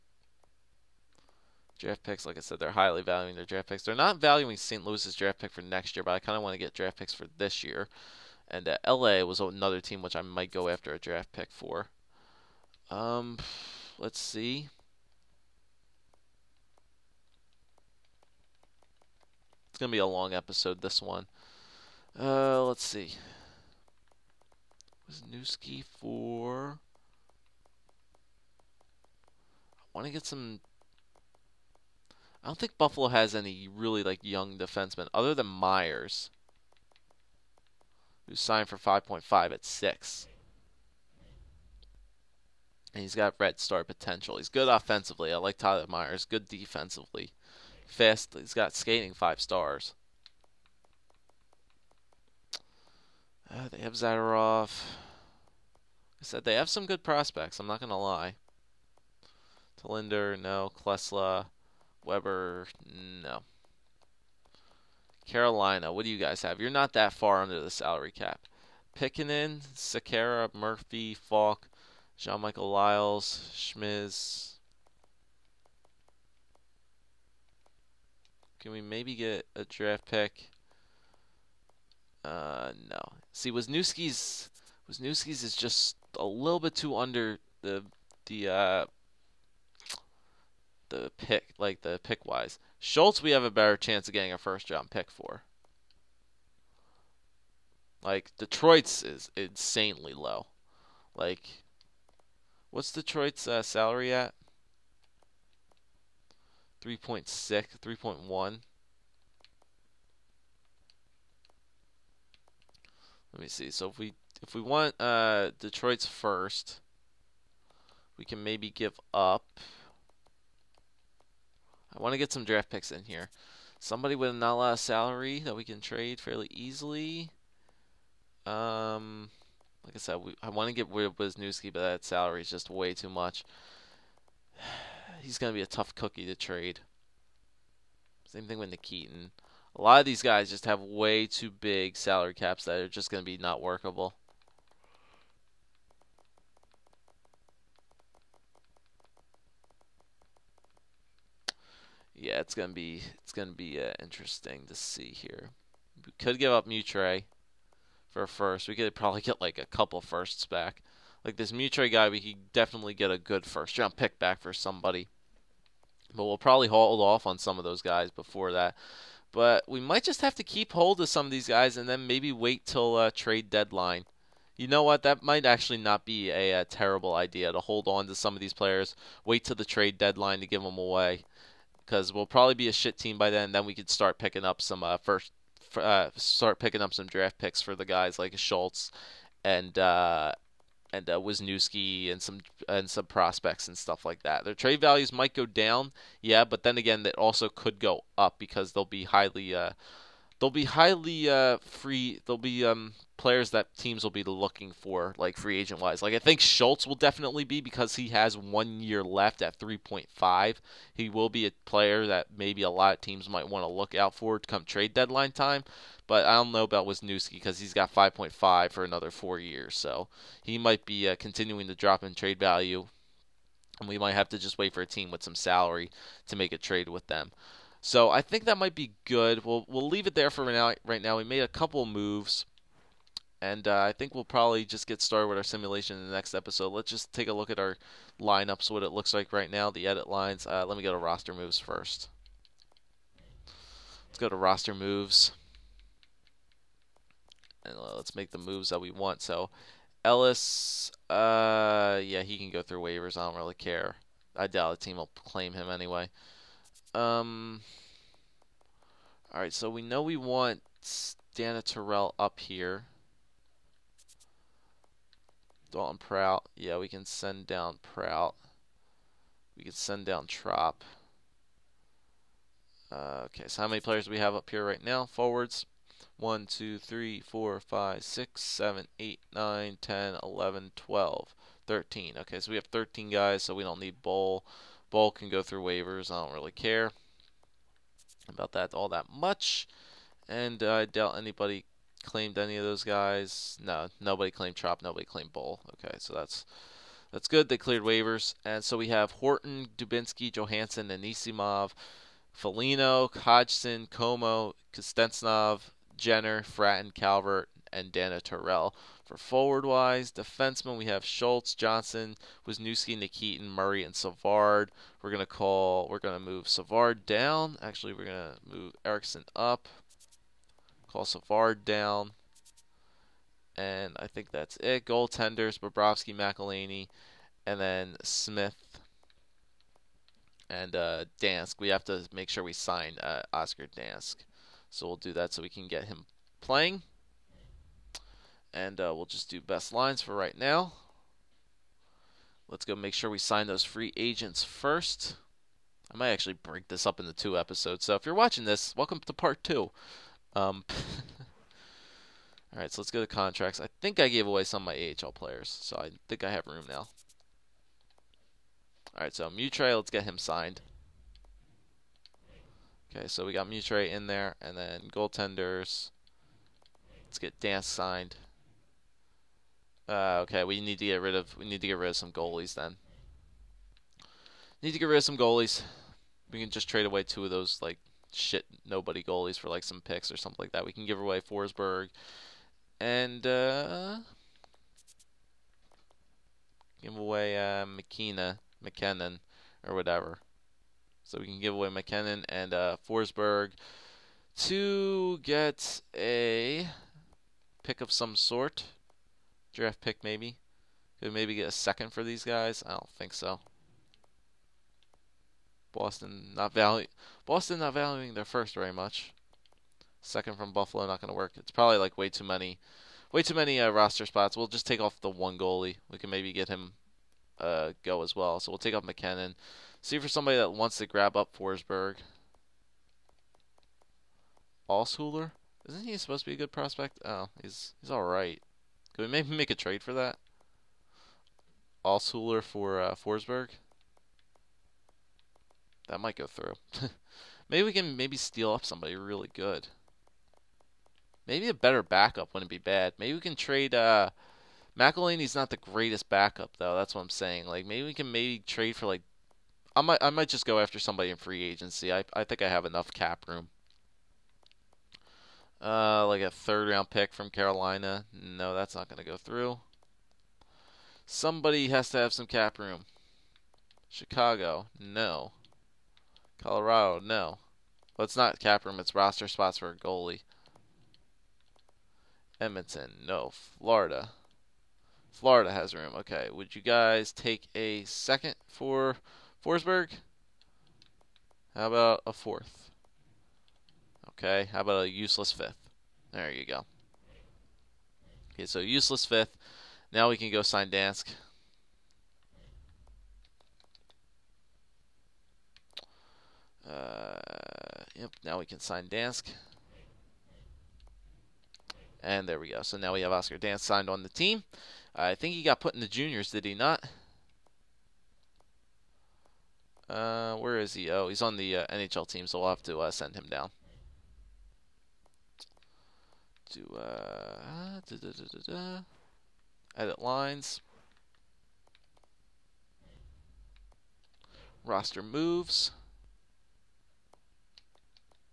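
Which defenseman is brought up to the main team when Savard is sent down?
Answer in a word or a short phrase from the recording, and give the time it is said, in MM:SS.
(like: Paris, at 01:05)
Erixon, at 05:18.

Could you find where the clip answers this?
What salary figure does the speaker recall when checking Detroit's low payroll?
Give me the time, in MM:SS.
01:46.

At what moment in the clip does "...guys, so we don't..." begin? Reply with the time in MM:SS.
04:43.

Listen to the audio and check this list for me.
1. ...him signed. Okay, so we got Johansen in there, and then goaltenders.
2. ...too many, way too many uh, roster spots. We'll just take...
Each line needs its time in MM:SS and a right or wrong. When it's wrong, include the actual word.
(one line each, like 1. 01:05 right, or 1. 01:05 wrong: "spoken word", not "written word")
1. 06:00 wrong: "Mutray", not "Johansen"
2. 06:52 right.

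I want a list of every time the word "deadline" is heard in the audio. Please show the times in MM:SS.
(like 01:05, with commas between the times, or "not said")
02:53, 02:59, 03:34.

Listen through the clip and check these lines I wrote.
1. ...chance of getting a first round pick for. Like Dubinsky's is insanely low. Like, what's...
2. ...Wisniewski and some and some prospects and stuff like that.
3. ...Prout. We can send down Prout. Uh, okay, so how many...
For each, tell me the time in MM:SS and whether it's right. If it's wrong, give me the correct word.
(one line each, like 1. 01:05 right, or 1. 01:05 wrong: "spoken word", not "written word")
1. 01:33 wrong: "Detroit", not "Dubinsky"
2. 03:11 right
3. 04:27 wrong: "Tropp", not "Prout".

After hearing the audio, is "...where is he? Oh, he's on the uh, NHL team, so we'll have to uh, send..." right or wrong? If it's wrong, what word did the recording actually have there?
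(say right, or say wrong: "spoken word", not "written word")
right.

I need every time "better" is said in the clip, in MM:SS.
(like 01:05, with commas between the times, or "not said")
01:33, 07:21.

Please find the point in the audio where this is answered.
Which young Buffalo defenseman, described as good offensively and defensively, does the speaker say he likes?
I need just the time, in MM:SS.
00:45.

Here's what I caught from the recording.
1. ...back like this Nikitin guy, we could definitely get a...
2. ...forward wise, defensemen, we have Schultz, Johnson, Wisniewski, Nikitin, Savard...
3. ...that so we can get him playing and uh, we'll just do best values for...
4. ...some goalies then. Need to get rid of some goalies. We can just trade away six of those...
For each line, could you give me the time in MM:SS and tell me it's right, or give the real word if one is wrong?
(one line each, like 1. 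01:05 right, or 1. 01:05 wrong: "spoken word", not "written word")
1. 02:40 wrong: "Mitre", not "Nikitin"
2. 05:09 wrong: "Murray", not "Savard"
3. 05:35 wrong: "lines", not "values"
4. 06:11 wrong: "two", not "six".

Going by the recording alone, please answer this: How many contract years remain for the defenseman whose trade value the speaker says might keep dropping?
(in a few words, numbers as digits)
4.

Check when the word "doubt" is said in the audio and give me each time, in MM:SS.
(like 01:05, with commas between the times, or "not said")
04:14, 04:50.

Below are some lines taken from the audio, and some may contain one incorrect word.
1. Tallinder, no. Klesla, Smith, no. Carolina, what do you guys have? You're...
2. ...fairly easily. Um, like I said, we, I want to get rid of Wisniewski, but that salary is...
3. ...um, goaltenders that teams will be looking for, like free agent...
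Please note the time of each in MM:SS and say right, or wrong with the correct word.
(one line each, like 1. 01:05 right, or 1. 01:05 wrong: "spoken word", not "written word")
1. 00:59 wrong: "Weber", not "Smith"
2. 02:06 right
3. 03:22 wrong: "players", not "goaltenders".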